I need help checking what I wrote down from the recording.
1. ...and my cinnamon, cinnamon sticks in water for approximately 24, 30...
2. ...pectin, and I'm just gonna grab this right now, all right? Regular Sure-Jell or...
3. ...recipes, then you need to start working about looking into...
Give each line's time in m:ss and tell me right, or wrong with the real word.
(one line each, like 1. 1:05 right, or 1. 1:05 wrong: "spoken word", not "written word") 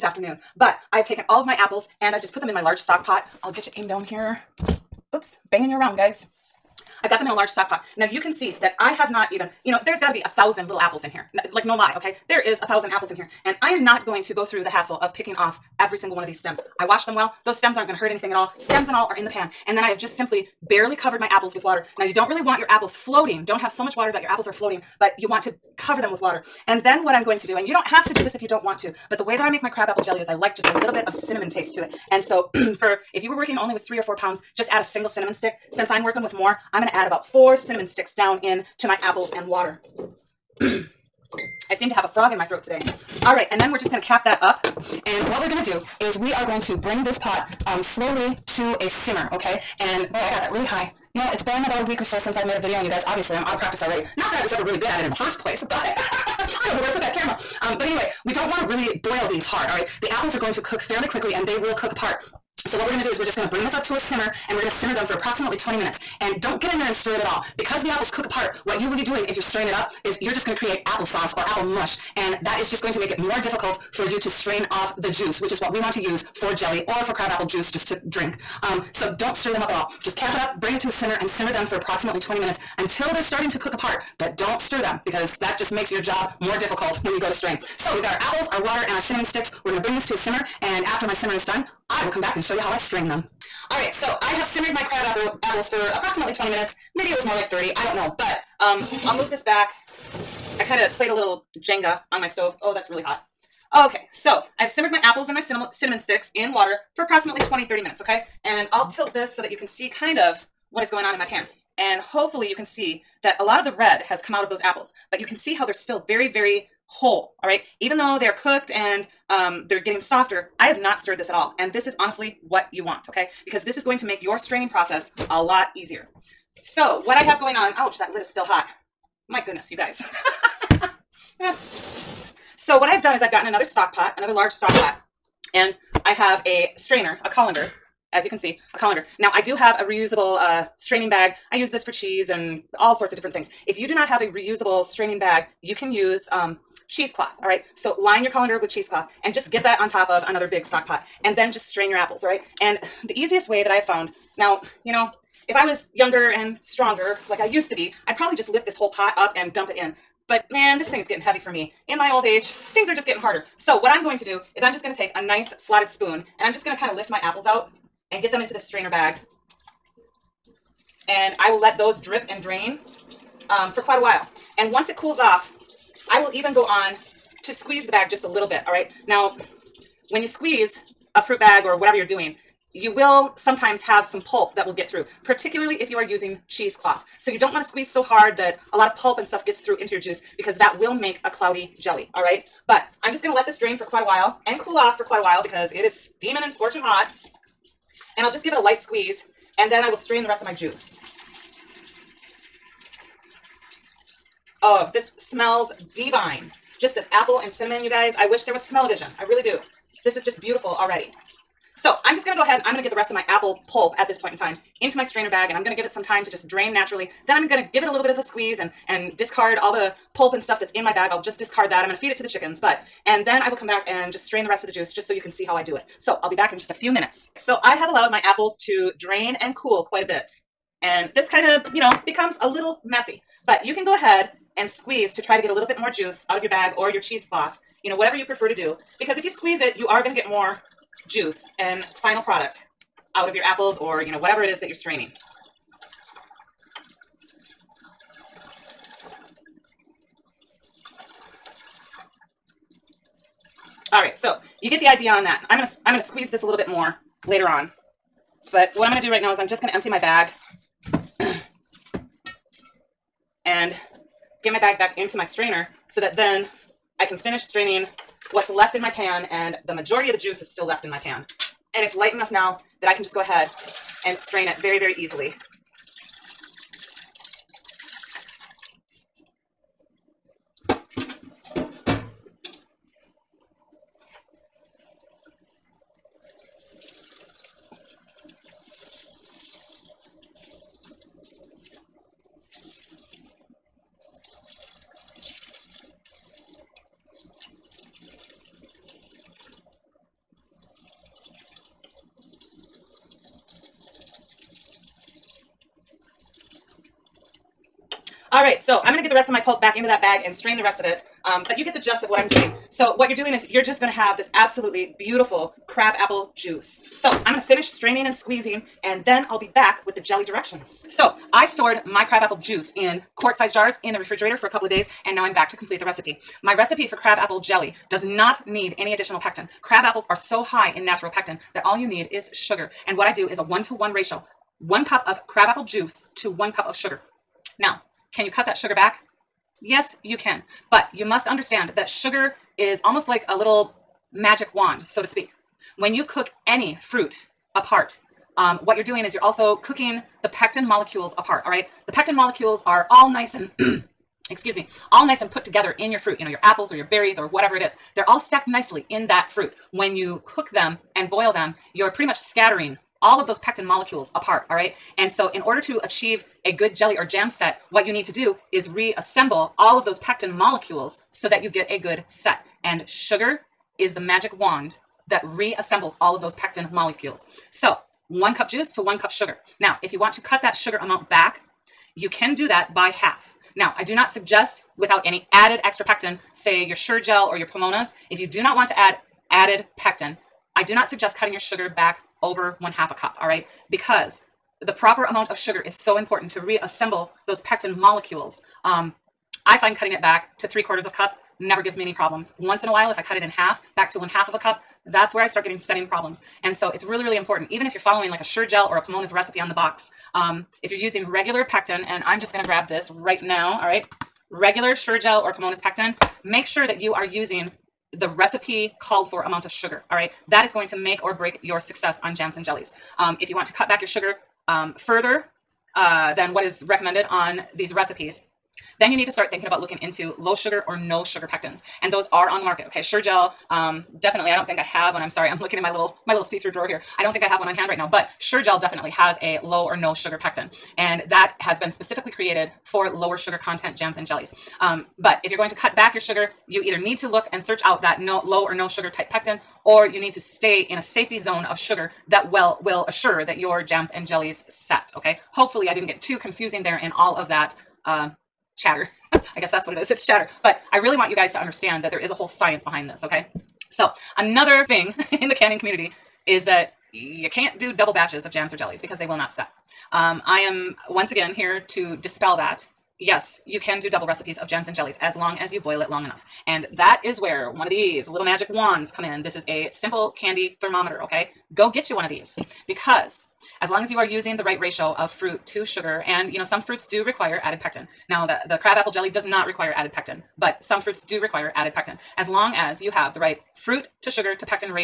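1. 1:45 wrong: "20", not "24"
2. 6:51 right
3. 7:07 wrong: "thinking", not "working".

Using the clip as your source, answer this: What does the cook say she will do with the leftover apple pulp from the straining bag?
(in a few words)
Feed it to the chickens.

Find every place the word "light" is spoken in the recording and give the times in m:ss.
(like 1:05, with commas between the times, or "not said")
3:18, 4:31.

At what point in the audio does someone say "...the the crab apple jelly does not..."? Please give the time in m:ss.
8:08.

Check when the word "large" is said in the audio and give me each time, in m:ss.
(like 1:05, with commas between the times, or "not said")
0:02, 0:07, 2:14.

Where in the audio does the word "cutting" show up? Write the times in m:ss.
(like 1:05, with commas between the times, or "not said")
6:31, 6:39.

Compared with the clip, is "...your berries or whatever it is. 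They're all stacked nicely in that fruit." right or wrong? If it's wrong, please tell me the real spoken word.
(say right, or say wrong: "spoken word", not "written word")
right.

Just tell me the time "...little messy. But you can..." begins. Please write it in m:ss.
3:52.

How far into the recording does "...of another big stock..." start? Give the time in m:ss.
2:30.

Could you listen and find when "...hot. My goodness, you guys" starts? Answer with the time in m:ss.
2:08.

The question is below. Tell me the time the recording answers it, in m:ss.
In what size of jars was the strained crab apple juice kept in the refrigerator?
5:23.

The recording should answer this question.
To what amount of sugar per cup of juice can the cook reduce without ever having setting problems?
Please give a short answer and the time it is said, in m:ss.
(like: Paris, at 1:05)
3/4 cup, at 6:40.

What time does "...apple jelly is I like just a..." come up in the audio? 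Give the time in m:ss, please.
0:29.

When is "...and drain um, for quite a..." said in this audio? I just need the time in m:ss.
2:52.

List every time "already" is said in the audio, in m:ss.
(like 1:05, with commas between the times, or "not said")
0:53, 3:30.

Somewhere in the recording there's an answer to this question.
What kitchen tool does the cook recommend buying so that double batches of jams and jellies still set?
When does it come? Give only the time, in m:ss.
8:00.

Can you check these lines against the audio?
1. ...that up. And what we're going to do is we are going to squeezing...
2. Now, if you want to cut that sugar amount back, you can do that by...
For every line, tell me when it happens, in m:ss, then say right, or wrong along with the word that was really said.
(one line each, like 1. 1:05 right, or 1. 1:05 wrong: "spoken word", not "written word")
1. 0:44 wrong: "bring", not "squeezing"
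2. 6:19 right.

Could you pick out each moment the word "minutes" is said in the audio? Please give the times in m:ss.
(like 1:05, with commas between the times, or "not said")
1:05, 1:22, 1:36, 1:47, 3:46.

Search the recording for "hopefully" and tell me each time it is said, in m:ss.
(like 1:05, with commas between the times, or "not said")
1:51, 7:35.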